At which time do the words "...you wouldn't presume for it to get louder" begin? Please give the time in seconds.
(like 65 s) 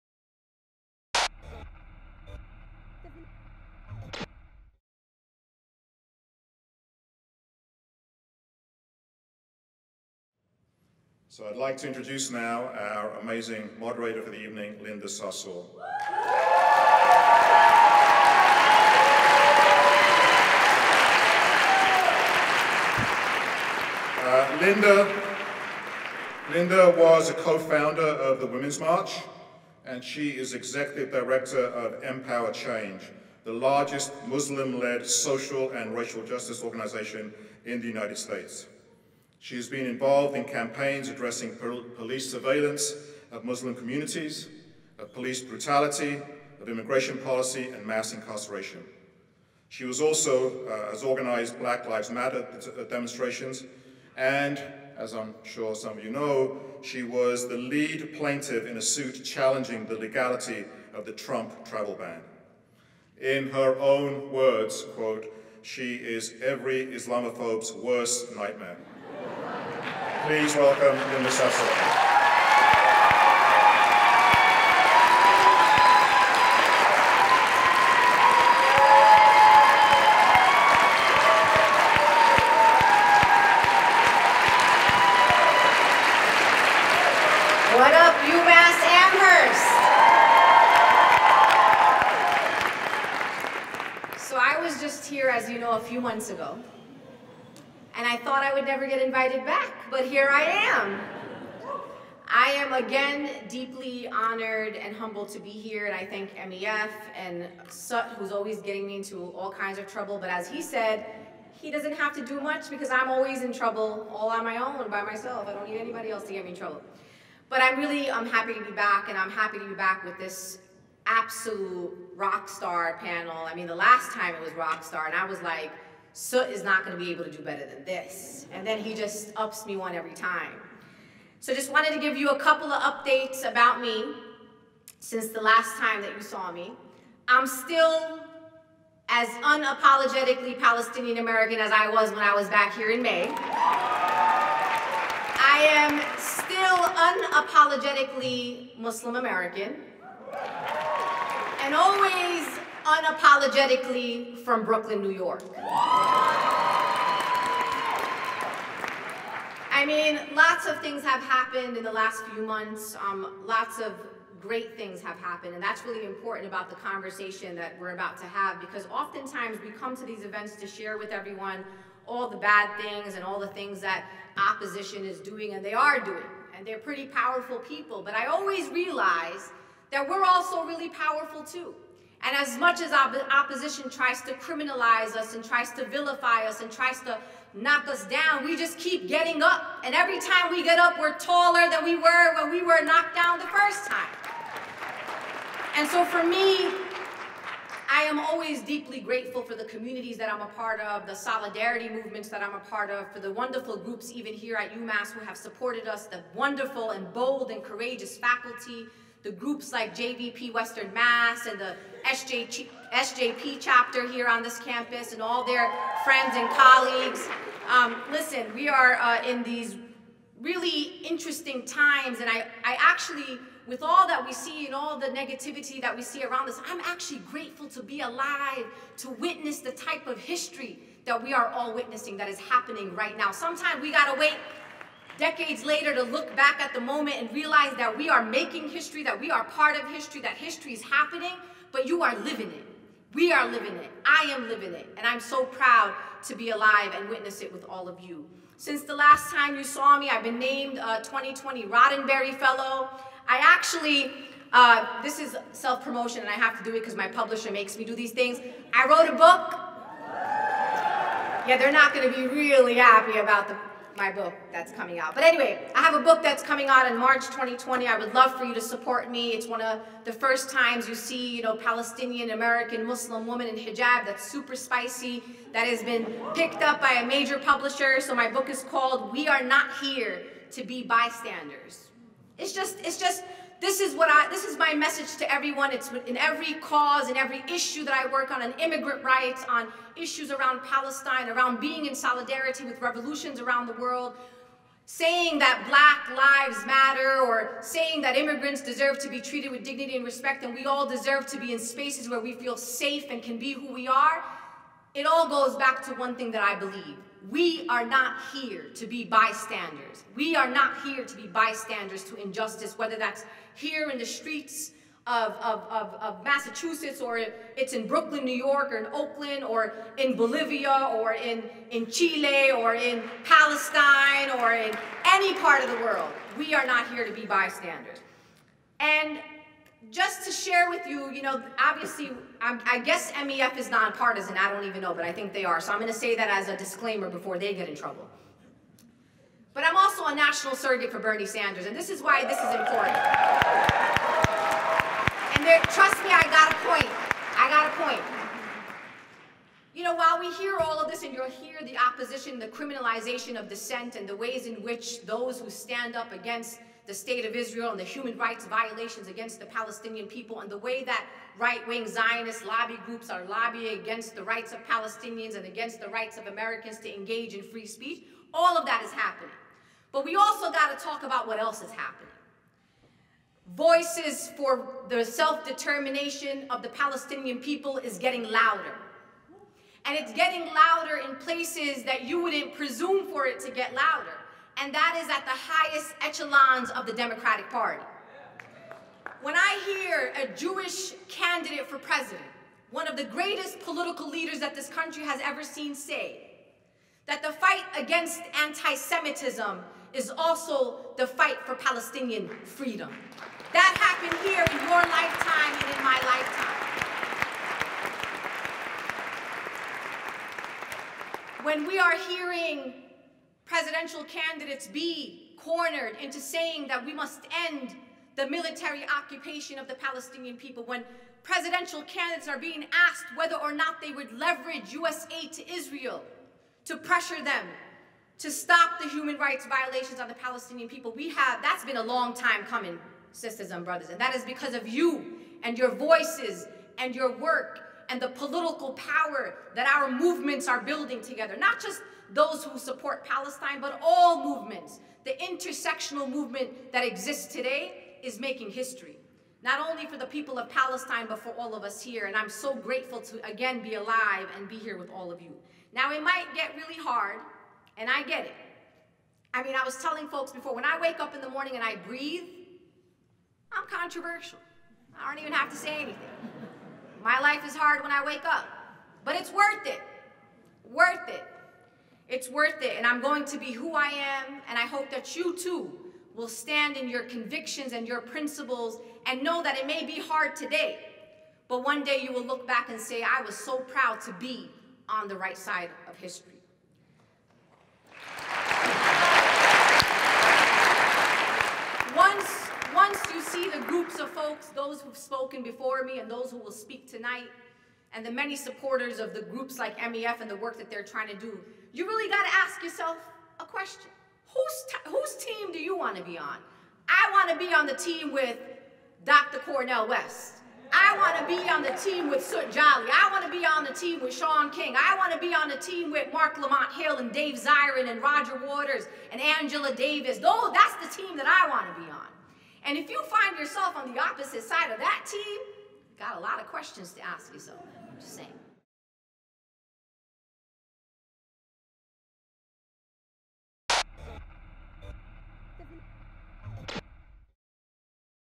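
382 s.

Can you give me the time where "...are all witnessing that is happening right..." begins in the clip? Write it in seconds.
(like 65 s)
231 s.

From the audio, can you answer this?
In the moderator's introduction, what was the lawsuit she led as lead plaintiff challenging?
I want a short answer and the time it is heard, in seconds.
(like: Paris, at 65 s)
Trump travel ban, at 61 s.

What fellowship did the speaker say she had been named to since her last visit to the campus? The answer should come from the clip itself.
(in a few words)
2020 Roddenberry Fellow.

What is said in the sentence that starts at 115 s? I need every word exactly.
I don't need anybody else to get me in trouble.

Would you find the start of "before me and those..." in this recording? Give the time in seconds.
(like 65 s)
495 s.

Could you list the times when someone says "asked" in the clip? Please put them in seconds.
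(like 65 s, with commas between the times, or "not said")
422 s.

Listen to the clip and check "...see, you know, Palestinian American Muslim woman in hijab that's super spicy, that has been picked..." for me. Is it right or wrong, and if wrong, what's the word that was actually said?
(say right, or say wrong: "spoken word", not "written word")
right.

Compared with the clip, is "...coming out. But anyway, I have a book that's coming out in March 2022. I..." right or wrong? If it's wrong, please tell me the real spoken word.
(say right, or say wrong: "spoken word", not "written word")
wrong: "2020", not "2022".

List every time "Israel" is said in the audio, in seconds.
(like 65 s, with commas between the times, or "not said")
357 s, 425 s.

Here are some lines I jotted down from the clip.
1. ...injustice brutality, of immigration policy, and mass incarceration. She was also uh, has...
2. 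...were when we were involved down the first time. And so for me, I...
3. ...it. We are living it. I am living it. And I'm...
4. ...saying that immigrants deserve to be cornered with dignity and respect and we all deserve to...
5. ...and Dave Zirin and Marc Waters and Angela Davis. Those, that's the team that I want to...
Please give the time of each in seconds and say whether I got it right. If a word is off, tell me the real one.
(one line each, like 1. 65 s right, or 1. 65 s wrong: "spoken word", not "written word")
1. 45 s wrong: "police", not "injustice"
2. 191 s wrong: "knocked", not "involved"
3. 242 s right
4. 297 s wrong: "treated", not "cornered"
5. 516 s wrong: "Roger", not "Marc".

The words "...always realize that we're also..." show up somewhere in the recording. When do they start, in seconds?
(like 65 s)
178 s.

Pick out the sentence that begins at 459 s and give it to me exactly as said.
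I mean, I was telling folks before, when I wake up in the morning and I breathe, I'm controversial.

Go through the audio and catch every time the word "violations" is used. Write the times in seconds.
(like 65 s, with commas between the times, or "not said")
358 s, 429 s.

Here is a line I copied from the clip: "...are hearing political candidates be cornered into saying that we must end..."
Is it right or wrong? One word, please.
wrong.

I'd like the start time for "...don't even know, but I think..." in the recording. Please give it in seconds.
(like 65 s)
334 s.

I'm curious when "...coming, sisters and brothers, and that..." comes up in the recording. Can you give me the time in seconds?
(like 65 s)
432 s.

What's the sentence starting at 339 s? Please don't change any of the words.
But I'm also a national surrogate for Bernie Sanders, and this is why this is important.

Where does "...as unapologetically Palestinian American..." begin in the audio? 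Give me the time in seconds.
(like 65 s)
139 s.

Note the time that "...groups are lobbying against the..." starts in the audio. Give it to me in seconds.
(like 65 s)
362 s.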